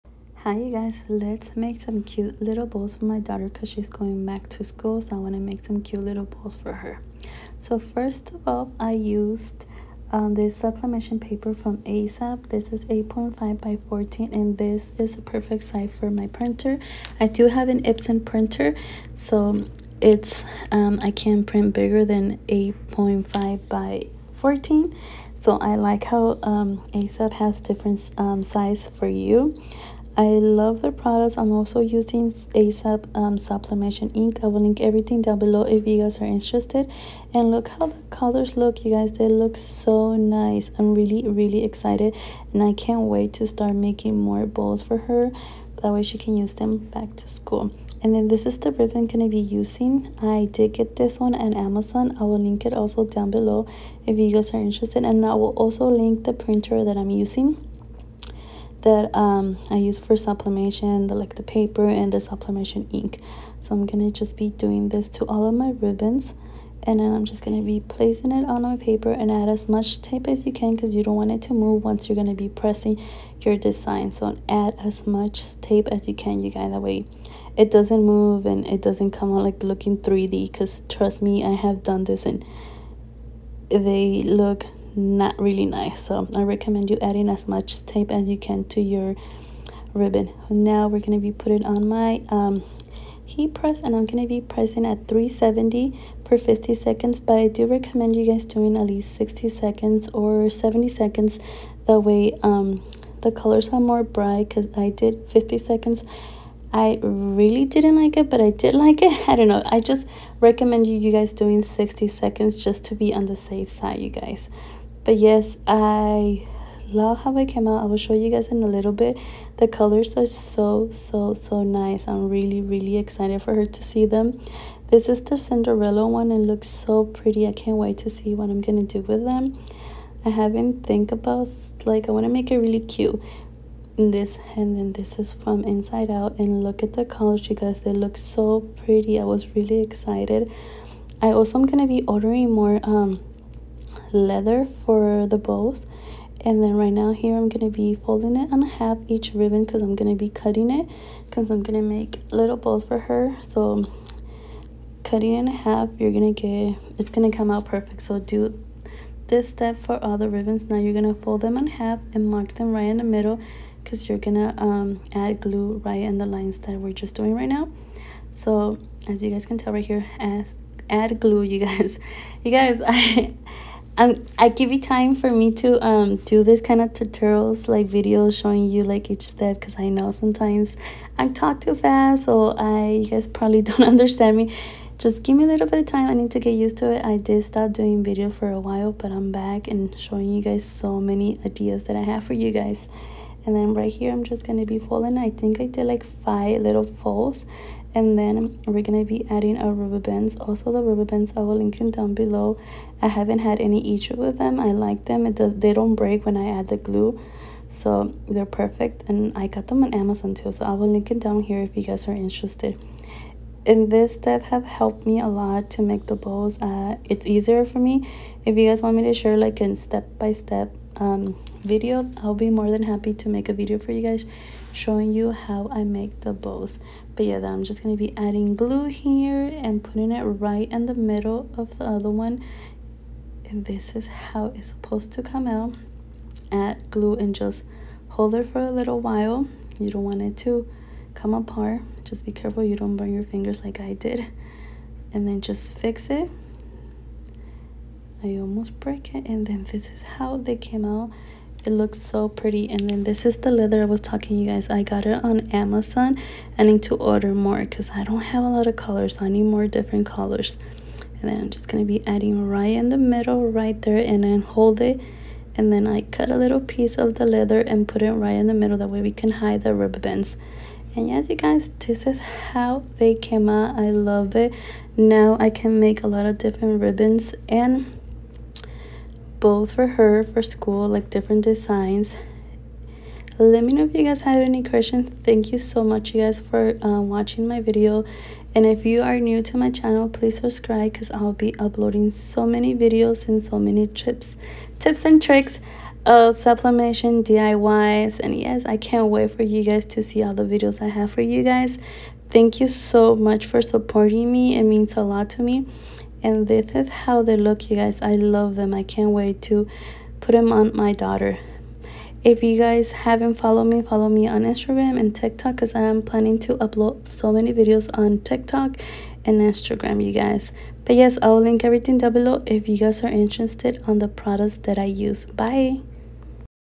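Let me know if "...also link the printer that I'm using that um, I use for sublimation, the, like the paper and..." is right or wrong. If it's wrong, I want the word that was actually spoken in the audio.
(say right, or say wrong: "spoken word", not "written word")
right.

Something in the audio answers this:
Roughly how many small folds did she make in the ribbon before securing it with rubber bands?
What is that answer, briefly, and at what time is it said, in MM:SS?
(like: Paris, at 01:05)
5, at 03:16.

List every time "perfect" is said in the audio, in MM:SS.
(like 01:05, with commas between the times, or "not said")
00:15, 02:37, 03:28.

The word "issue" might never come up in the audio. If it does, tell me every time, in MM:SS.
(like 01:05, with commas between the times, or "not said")
03:23.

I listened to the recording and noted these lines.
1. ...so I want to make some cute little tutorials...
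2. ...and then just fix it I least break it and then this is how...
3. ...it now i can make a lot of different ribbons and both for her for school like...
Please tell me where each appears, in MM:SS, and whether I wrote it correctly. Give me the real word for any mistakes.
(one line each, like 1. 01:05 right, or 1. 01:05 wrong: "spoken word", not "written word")
1. 00:04 wrong: "balls", not "tutorials"
2. 04:05 wrong: "almost", not "least"
3. 04:34 right.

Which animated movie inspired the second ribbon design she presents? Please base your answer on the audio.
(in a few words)
Inside Out.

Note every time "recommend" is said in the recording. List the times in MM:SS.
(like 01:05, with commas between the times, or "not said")
01:26, 01:37, 01:50.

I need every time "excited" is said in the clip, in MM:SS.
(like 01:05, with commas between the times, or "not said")
00:41, 02:02, 02:19.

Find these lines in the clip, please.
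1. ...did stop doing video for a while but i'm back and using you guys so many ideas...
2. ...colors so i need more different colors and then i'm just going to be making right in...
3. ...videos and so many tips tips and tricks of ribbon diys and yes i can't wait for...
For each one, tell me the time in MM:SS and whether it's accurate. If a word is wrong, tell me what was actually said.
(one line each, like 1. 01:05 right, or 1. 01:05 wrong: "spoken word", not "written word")
1. 03:07 wrong: "showing", not "using"
2. 04:18 wrong: "adding", not "making"
3. 04:52 wrong: "sublimation", not "ribbon".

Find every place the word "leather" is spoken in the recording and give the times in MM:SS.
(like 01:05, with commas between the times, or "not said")
02:24, 04:13, 04:27.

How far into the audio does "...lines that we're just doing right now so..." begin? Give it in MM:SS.
02:46.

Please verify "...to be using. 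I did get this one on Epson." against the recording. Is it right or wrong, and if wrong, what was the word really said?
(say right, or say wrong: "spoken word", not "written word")
wrong: "Amazon", not "Epson".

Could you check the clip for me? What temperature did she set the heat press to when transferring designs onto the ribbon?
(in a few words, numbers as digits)
370.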